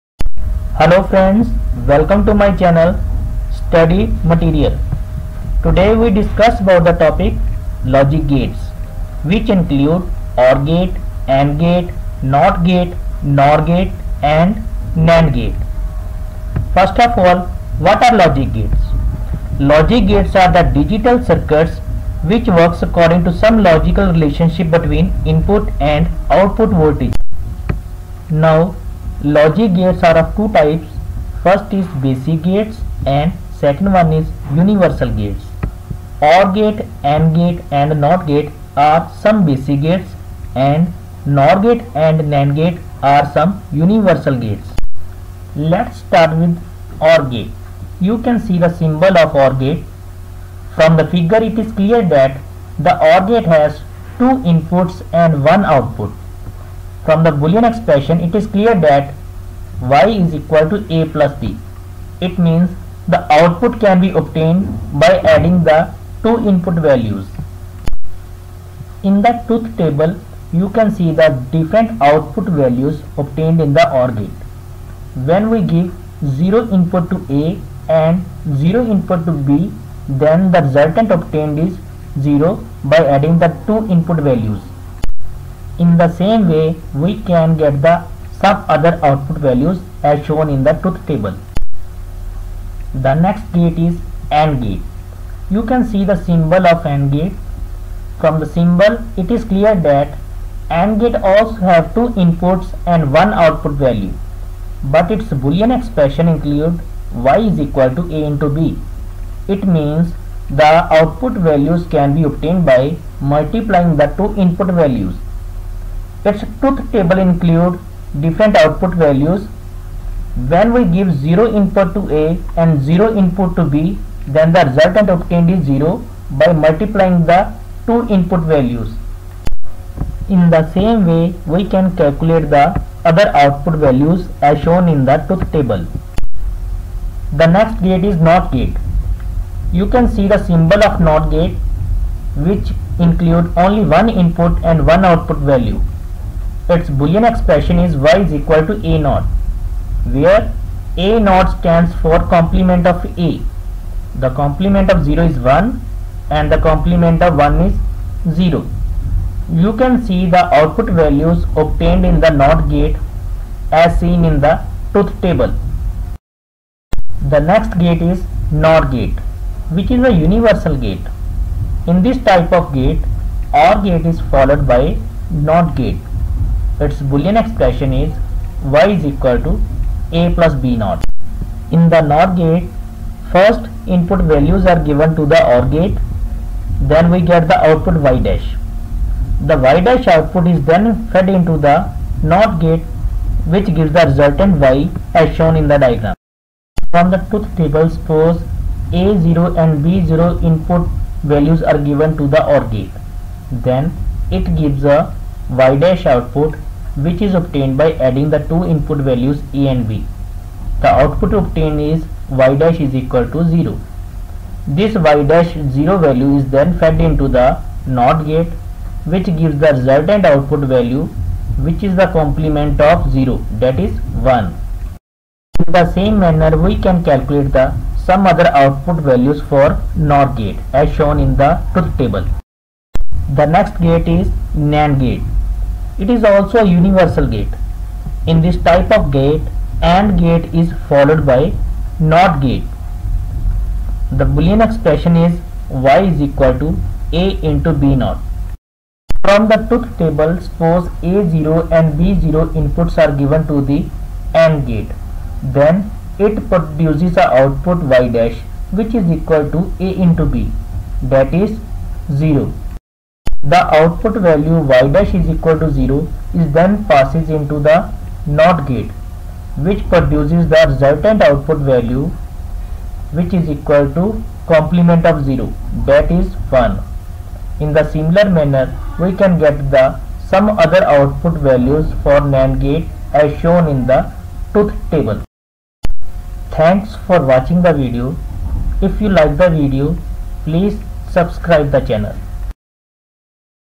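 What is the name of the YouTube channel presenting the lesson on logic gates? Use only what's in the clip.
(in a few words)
Study Material.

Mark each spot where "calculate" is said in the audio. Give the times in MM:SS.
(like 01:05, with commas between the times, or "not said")
02:11, 03:47.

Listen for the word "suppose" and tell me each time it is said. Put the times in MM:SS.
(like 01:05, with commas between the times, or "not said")
03:17, 04:10.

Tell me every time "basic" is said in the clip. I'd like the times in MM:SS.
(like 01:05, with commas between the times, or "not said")
00:32, 00:39.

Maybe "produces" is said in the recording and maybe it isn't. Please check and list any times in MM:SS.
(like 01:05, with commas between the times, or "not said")
04:16, 04:29.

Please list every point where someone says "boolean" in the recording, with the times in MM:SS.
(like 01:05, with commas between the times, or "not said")
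00:57, 01:45, 02:26, 02:57, 04:04.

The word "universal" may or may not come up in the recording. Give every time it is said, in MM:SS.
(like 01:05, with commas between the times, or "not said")
00:34, 00:43, 02:50, 03:56.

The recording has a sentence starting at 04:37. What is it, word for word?
In the similar manner we can get the some other output values for NAND gate as shown in the truth table.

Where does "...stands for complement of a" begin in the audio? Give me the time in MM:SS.
02:31.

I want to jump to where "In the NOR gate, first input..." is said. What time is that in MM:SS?
03:01.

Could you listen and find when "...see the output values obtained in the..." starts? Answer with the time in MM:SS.
02:40.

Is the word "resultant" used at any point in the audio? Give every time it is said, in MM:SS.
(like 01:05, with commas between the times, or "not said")
01:20, 02:04, 03:14, 03:39, 04:30.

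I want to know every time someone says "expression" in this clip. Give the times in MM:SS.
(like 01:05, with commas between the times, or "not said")
00:57, 01:45, 02:27, 02:57, 04:04.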